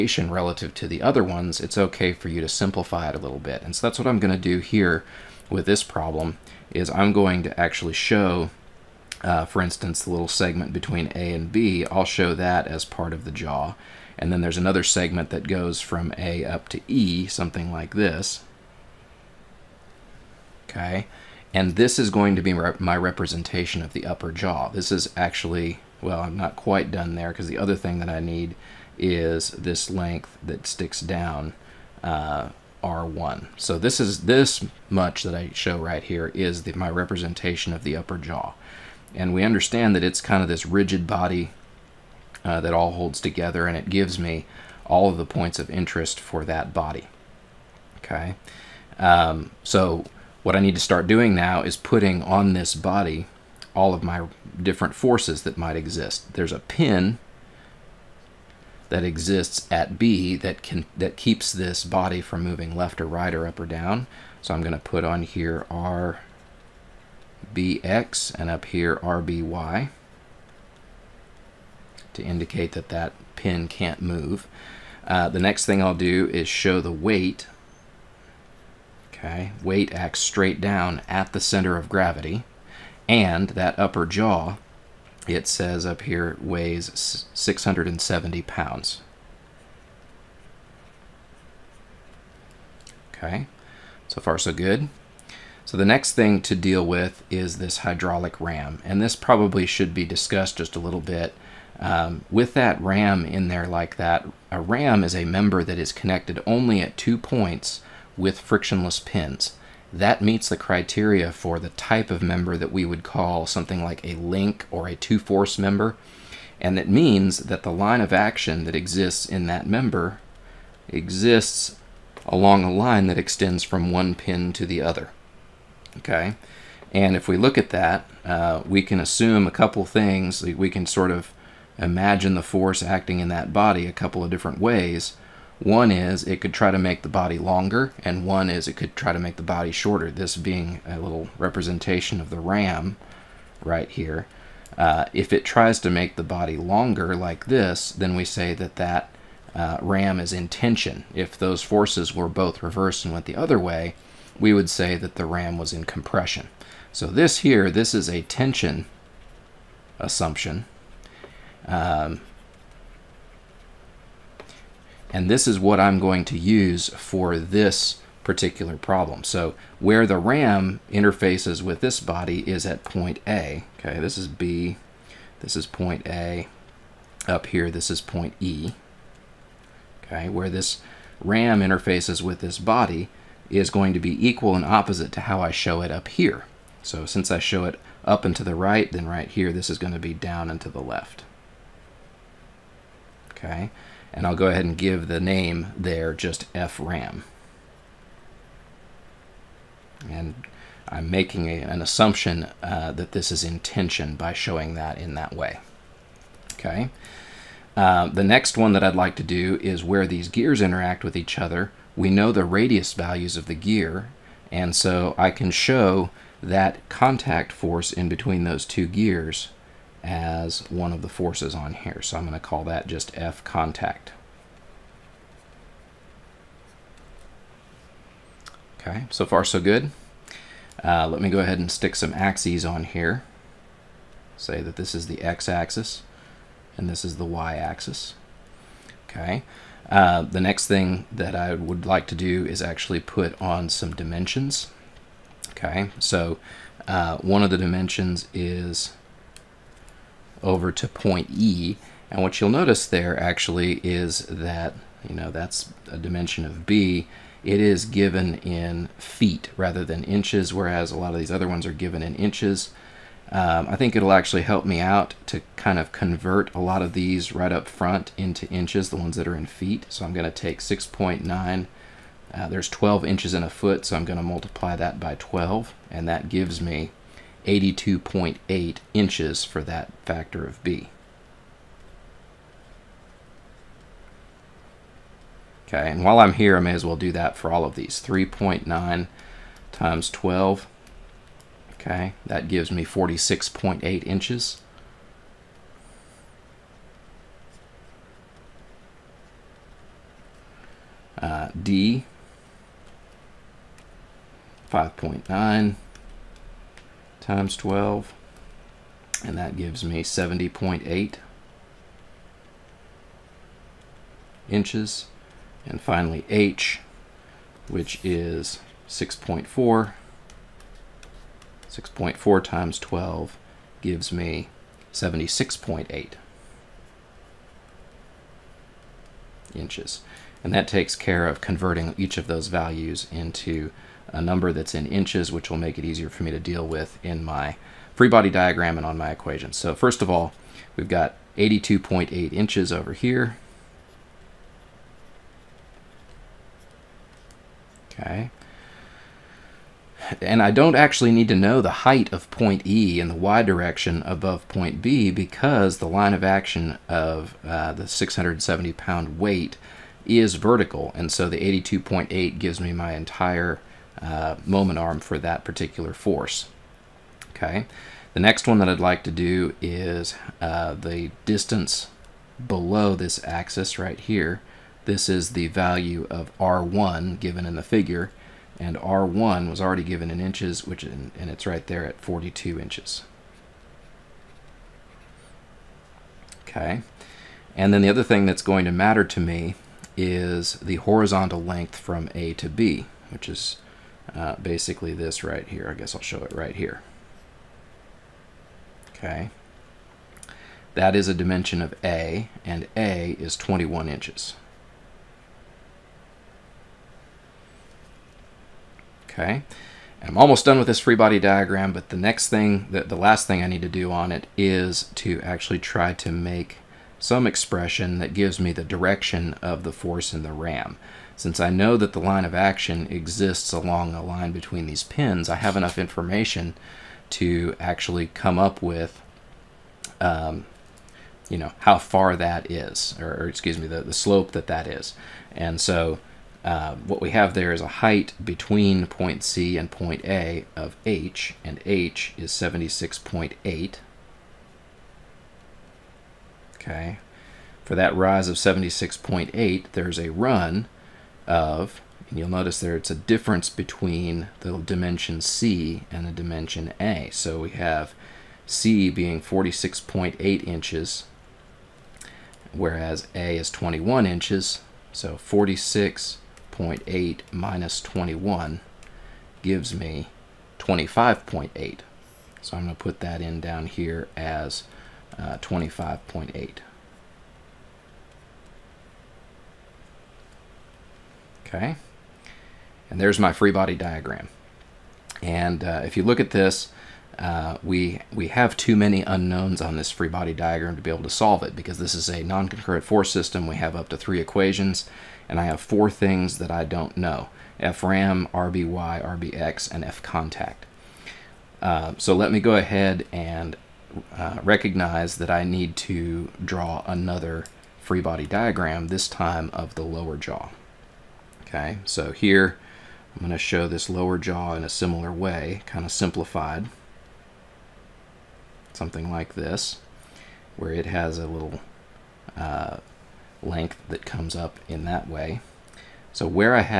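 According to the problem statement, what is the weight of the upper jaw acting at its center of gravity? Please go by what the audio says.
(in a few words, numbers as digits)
670 pounds.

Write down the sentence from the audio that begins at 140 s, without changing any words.
This being a little representation of the ram right here.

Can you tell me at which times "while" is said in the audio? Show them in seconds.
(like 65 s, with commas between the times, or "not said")
286 s.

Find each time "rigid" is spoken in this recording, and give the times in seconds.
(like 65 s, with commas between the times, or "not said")
40 s.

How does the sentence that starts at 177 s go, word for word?
Up here, this is point E.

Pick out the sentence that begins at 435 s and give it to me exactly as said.
And so um, what we have there is a height between point C and point A of h, and h is 76.8.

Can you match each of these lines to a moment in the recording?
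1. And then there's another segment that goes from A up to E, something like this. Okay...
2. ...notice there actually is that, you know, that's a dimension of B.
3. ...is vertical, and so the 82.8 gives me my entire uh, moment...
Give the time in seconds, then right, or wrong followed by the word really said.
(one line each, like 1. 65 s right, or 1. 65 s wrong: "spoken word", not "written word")
1. 14 s right
2. 252 s right
3. 360 s right.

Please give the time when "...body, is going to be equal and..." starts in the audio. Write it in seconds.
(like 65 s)
182 s.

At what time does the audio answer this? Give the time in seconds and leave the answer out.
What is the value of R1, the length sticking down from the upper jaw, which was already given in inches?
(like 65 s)
381 s.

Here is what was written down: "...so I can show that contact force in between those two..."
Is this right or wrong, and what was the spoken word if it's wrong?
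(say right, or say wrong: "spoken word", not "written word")
right.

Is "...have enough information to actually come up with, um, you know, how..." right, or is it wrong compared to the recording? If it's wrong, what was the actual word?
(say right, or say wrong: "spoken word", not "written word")
right.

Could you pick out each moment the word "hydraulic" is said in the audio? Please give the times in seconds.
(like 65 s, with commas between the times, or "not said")
97 s.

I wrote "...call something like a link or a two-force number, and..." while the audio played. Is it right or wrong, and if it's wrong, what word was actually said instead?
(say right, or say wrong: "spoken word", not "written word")
wrong: "member", not "number".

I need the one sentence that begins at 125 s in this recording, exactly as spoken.
Okay, and if we look at that, uh, we can assume a couple things.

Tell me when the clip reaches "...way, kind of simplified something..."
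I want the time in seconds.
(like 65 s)
515 s.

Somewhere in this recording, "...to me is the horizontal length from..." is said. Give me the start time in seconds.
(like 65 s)
389 s.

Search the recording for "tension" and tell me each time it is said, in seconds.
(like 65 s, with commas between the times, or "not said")
150 s, 158 s, 203 s.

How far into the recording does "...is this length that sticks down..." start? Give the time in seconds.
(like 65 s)
28 s.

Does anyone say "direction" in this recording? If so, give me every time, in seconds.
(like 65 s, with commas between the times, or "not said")
353 s, 418 s.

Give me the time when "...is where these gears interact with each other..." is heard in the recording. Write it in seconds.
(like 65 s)
209 s.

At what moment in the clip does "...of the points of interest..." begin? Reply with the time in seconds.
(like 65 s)
45 s.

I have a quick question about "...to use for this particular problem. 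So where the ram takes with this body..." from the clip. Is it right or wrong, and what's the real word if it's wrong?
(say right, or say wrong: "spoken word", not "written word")
wrong: "interfaces", not "takes".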